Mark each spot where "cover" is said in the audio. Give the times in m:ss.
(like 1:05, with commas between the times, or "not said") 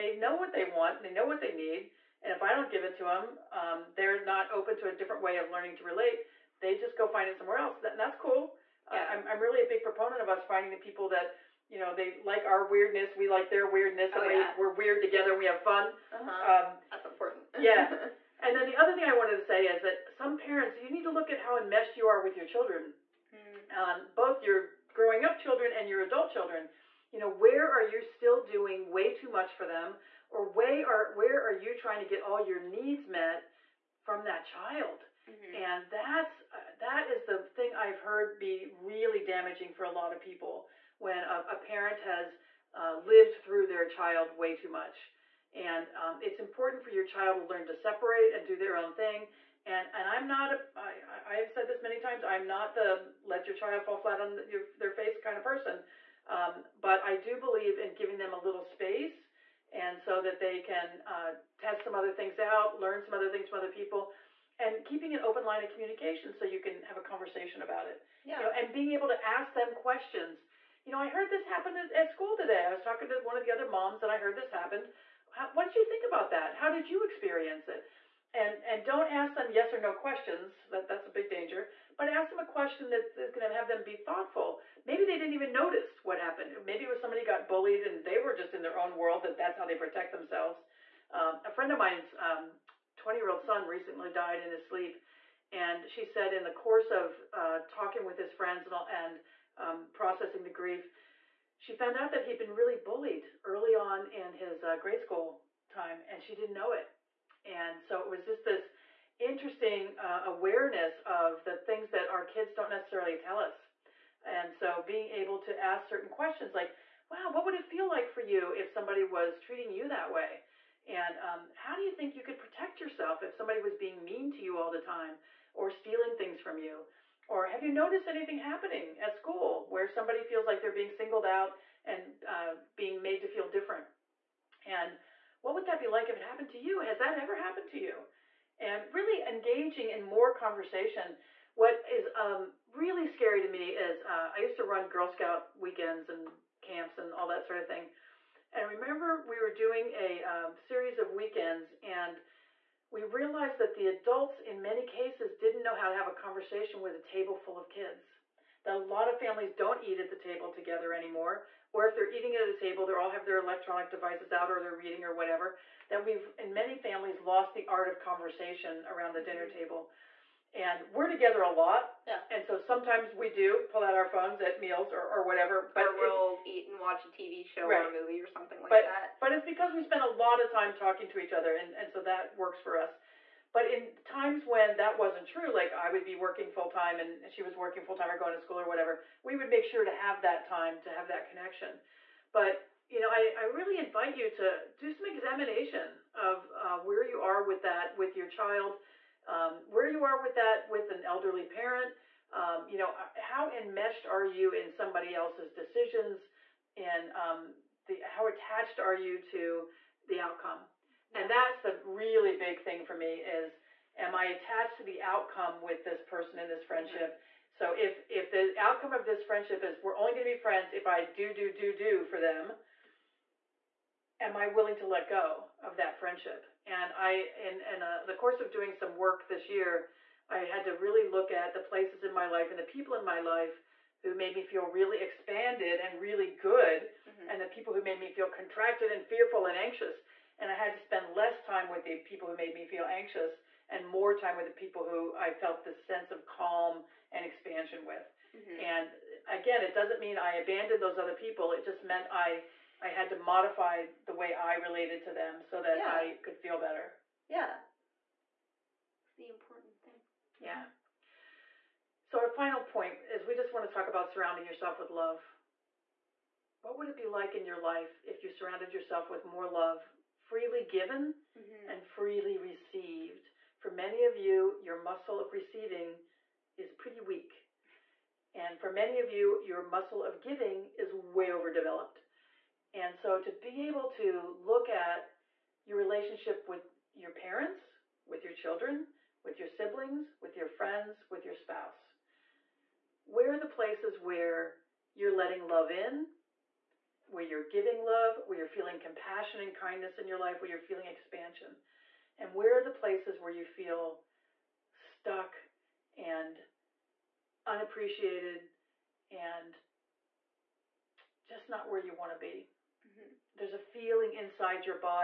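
not said.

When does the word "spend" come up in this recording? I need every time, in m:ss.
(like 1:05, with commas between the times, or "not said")
2:59, 4:00.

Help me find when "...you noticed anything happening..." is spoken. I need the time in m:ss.
2:07.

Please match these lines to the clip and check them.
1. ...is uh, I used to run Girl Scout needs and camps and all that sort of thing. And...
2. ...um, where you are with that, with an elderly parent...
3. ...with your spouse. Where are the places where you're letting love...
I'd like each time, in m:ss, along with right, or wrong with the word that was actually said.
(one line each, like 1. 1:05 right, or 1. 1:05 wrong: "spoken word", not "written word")
1. 2:23 wrong: "weekends", not "needs"
2. 3:19 right
3. 4:51 right.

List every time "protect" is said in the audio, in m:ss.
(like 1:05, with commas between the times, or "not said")
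1:29, 2:02.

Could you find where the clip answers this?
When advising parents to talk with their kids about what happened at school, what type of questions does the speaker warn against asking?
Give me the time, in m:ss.
1:19.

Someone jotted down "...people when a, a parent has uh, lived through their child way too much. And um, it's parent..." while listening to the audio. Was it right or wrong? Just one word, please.
wrong.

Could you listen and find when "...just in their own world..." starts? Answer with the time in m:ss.
1:28.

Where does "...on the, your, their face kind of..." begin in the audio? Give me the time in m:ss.
0:54.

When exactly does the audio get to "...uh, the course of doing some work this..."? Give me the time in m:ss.
3:47.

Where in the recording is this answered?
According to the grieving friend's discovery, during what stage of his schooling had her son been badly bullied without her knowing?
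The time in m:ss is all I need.
1:44.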